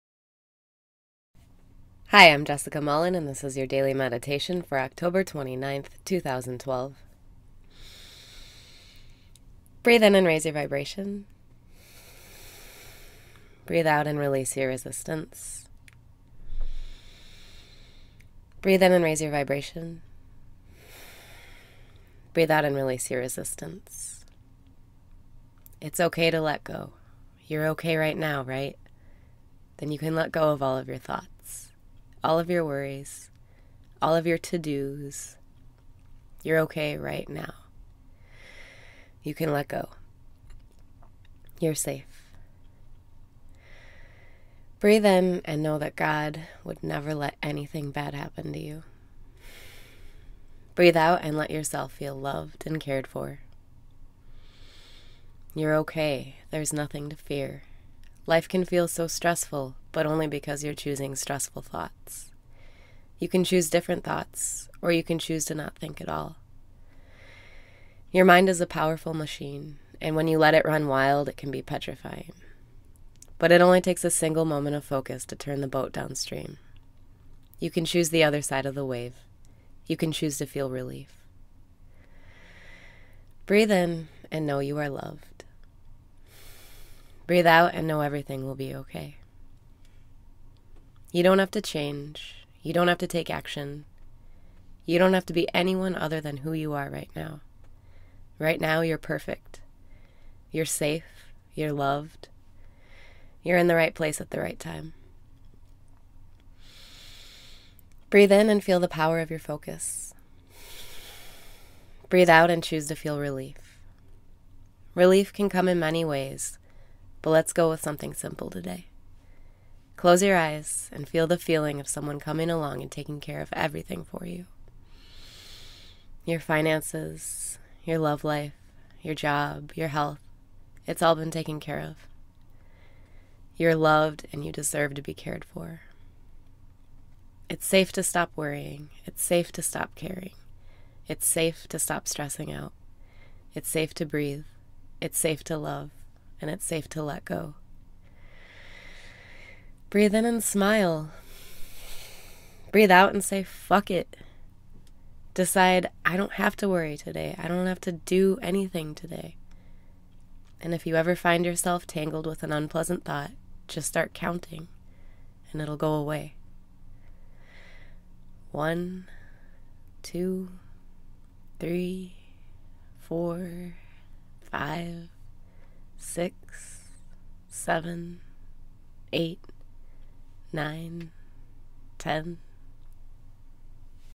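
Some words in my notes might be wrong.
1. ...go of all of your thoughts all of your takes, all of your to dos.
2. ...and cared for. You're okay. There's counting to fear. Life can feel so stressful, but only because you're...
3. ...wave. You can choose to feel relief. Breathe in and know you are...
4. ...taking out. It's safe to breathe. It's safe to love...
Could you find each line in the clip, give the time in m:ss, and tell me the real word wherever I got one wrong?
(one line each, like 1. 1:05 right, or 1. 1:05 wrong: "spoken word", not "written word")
1. 0:30 wrong: "worries", not "takes"
2. 0:52 wrong: "nothing", not "counting"
3. 1:18 right
4. 2:22 wrong: "stressing", not "taking".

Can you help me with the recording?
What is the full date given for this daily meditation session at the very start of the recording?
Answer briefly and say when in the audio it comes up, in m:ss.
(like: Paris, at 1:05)
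October 29th, 2012, at 0:04.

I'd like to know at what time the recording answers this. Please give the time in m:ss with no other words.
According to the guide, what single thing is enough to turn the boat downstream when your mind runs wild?
1:14.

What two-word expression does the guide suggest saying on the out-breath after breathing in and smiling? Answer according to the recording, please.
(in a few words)
fuck it.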